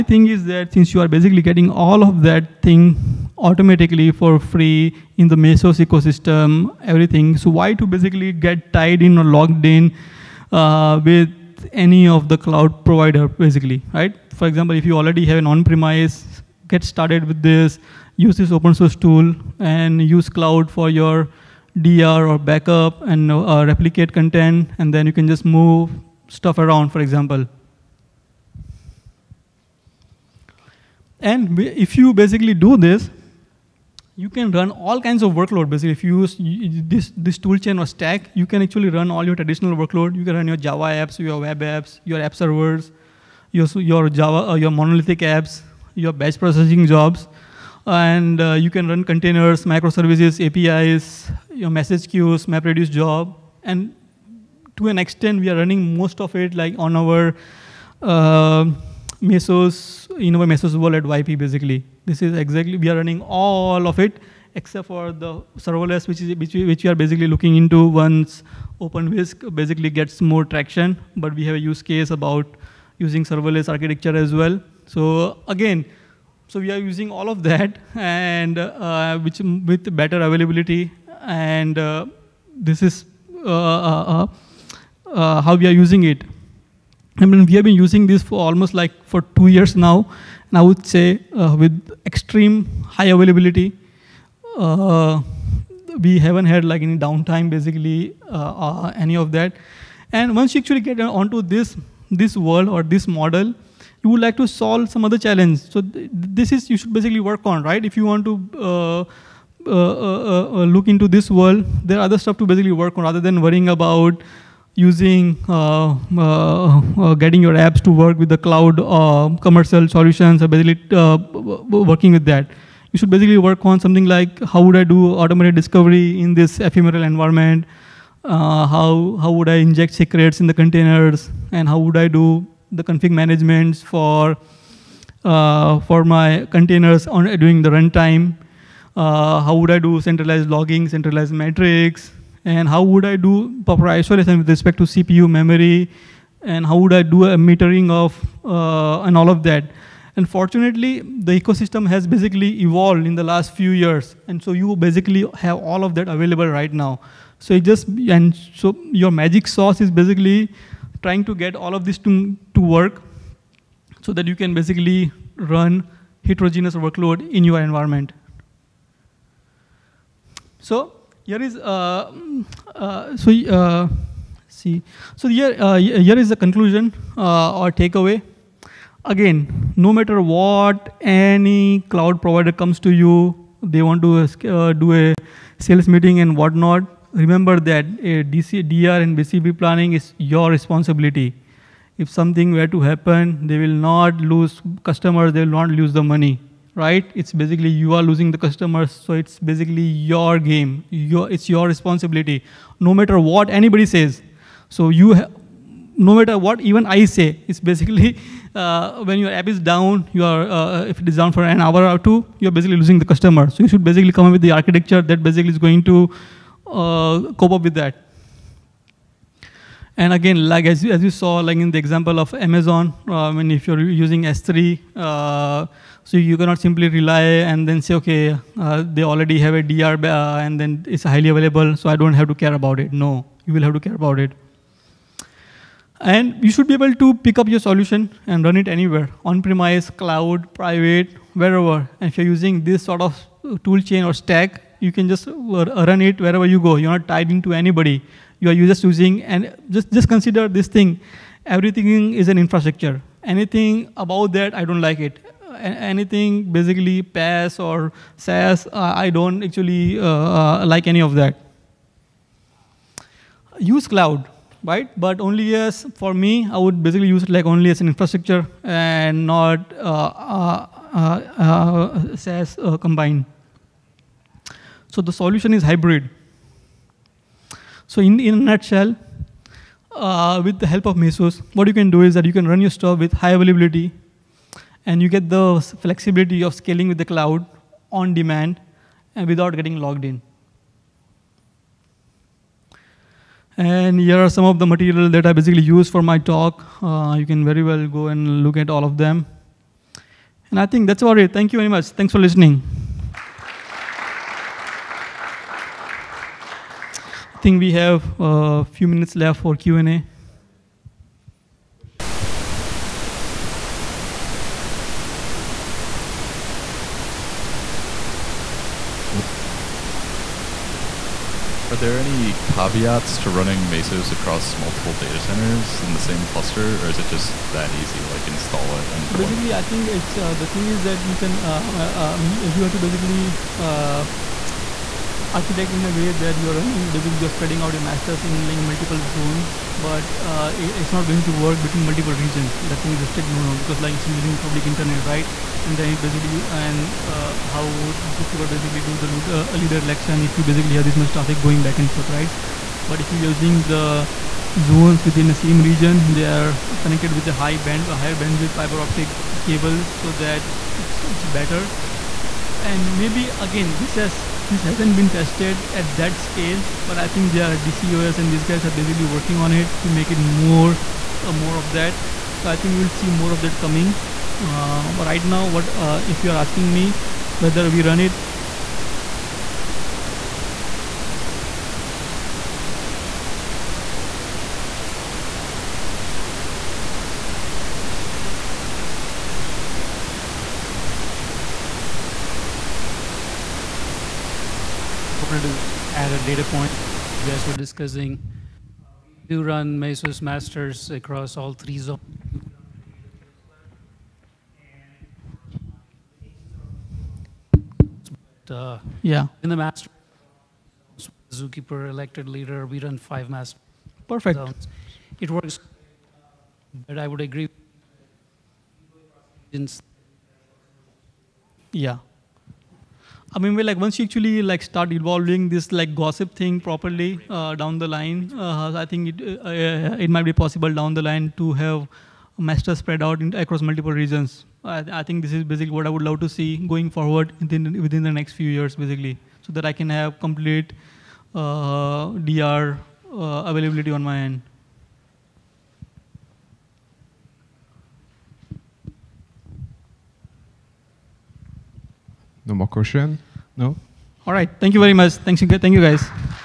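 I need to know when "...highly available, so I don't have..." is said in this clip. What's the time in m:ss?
3:51.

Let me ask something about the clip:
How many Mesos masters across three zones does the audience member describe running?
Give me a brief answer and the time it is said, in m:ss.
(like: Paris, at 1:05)
5, at 6:52.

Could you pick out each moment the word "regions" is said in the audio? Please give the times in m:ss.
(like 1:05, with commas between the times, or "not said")
5:42, 5:55, 7:13.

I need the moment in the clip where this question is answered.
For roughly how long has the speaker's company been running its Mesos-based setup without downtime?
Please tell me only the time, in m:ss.
1:29.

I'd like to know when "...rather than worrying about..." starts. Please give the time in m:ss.
1:53.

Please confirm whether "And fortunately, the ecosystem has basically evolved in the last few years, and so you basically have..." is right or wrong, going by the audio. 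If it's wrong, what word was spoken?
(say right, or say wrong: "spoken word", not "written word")
right.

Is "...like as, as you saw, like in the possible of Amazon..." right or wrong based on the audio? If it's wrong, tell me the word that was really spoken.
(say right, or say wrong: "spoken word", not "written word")
wrong: "example", not "possible".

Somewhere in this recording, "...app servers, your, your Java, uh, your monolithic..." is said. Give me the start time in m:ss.
0:42.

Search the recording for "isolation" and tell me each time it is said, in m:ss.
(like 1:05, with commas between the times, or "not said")
2:23.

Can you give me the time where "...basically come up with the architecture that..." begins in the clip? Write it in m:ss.
3:33.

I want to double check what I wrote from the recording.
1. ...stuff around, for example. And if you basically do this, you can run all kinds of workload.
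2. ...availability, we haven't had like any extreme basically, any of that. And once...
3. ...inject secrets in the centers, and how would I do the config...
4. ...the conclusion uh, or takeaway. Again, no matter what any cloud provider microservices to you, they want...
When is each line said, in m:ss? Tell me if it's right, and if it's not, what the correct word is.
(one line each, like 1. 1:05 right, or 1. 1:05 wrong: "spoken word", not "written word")
1. 0:26 right
2. 1:33 wrong: "downtime", not "extreme"
3. 2:09 wrong: "containers", not "centers"
4. 2:56 wrong: "comes", not "microservices".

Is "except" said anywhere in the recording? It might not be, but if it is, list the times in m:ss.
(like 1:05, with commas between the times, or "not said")
1:04.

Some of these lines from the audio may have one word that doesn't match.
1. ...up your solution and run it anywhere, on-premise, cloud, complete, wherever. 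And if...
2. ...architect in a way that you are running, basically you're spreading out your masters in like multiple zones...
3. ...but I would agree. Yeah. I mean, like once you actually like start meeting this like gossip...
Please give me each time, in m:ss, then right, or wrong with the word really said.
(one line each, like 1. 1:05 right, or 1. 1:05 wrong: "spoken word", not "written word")
1. 3:57 wrong: "private", not "complete"
2. 5:35 right
3. 6:56 wrong: "evolving", not "meeting".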